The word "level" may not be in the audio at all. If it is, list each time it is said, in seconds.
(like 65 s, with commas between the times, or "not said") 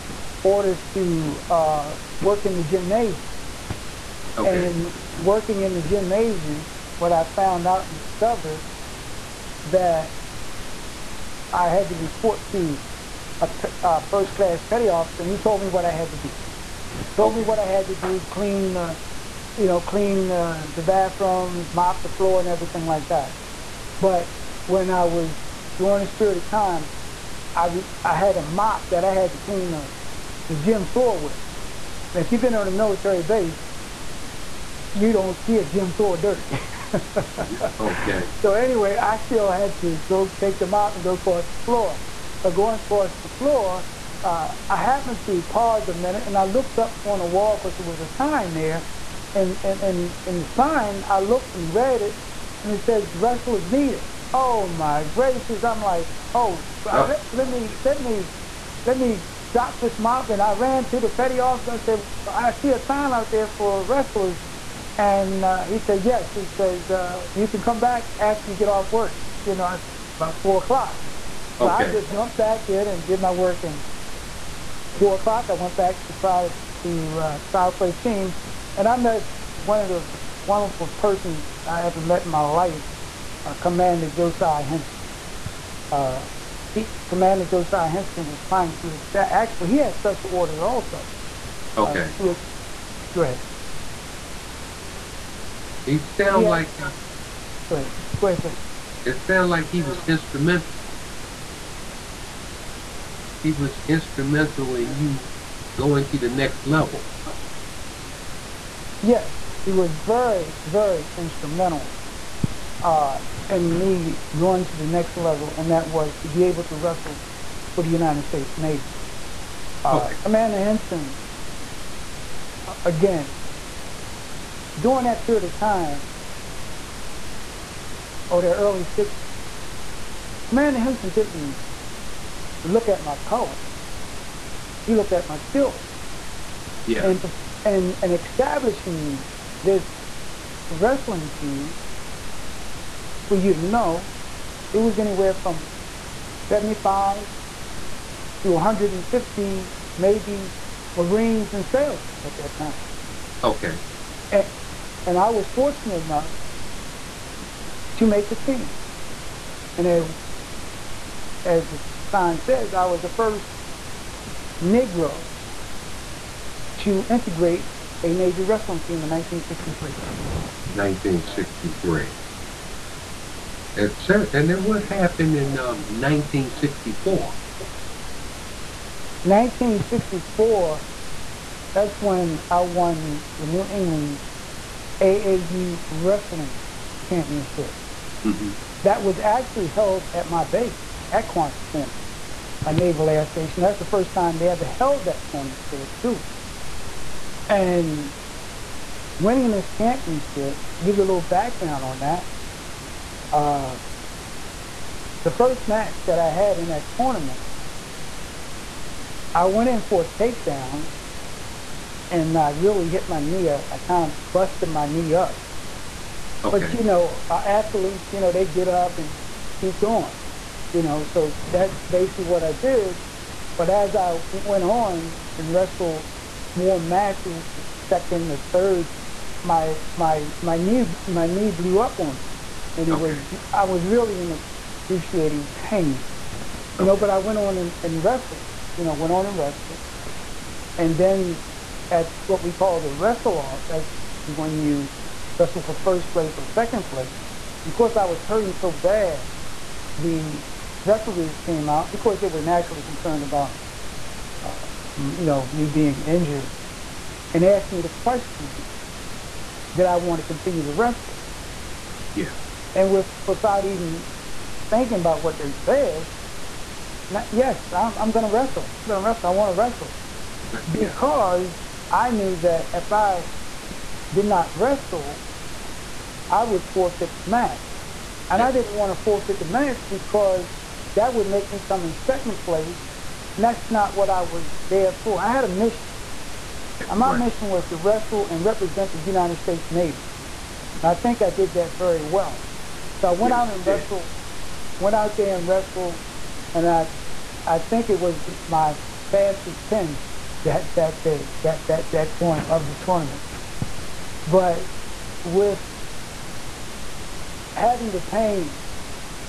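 106 s, 115 s.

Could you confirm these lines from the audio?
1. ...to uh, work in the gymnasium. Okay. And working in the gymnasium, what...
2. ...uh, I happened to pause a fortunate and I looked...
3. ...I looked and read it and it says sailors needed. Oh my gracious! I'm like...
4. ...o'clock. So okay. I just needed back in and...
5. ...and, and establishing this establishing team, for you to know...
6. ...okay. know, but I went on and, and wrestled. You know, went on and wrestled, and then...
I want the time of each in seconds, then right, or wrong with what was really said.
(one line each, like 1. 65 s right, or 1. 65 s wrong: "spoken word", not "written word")
1. 0 s right
2. 44 s wrong: "minute", not "fortunate"
3. 51 s wrong: "wrestlers", not "sailors"
4. 70 s wrong: "jumped", not "needed"
5. 137 s wrong: "wrestling", not "establishing"
6. 236 s right.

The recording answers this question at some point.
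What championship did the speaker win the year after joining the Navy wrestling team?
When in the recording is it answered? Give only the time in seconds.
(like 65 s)
183 s.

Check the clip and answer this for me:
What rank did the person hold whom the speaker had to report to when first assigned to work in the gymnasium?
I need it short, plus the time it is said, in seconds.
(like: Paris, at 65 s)
First class petty officer, at 14 s.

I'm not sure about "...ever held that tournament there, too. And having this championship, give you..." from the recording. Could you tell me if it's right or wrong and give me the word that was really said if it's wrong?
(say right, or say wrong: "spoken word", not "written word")
wrong: "winning", not "having".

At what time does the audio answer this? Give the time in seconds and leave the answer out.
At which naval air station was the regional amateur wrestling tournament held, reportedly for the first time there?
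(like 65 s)
191 s.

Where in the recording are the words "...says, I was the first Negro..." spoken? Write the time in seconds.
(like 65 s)
162 s.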